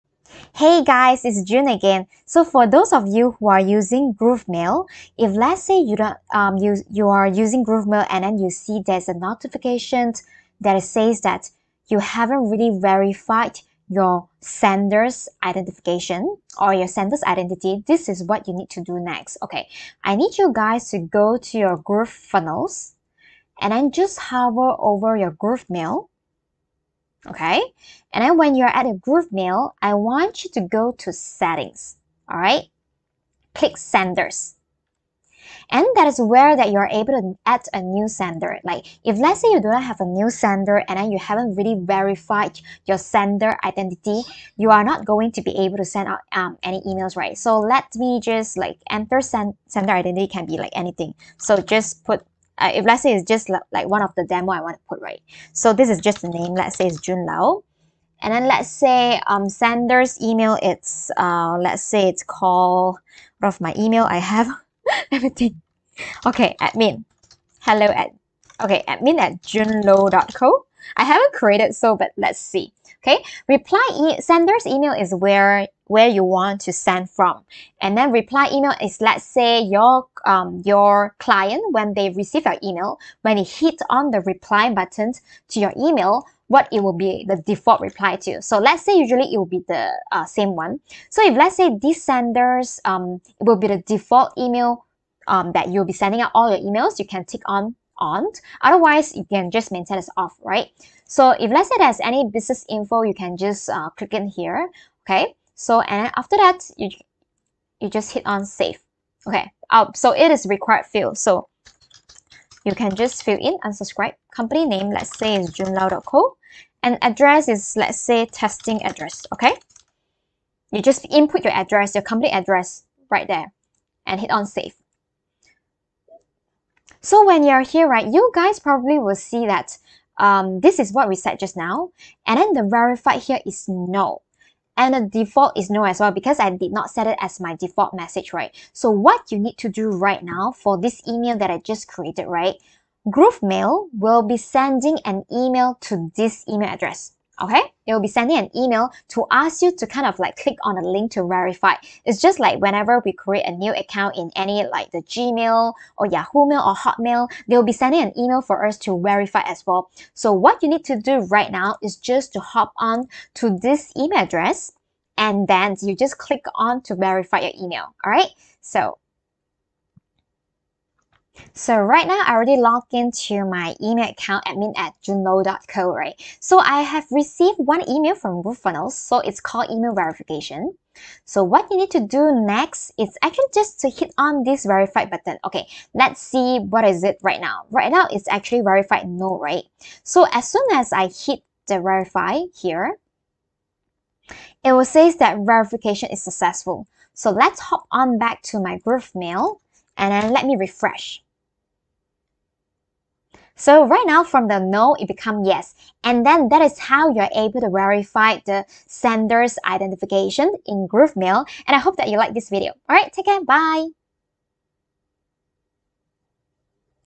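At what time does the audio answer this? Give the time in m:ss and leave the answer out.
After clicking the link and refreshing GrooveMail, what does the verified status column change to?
3:25.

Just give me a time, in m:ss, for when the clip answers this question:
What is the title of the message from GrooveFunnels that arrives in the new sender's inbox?
2:59.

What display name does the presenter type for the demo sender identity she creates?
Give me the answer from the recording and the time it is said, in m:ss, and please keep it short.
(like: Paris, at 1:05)
June Low, at 0:56.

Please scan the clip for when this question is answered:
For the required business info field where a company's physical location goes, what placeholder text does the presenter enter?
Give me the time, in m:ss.
1:58.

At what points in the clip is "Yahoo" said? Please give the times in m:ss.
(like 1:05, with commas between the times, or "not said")
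2:36.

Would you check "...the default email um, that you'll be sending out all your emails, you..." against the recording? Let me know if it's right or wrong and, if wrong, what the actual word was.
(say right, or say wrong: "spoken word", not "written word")
right.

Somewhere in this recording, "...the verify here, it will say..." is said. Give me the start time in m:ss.
3:11.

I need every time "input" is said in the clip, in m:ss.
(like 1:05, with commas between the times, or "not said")
2:01.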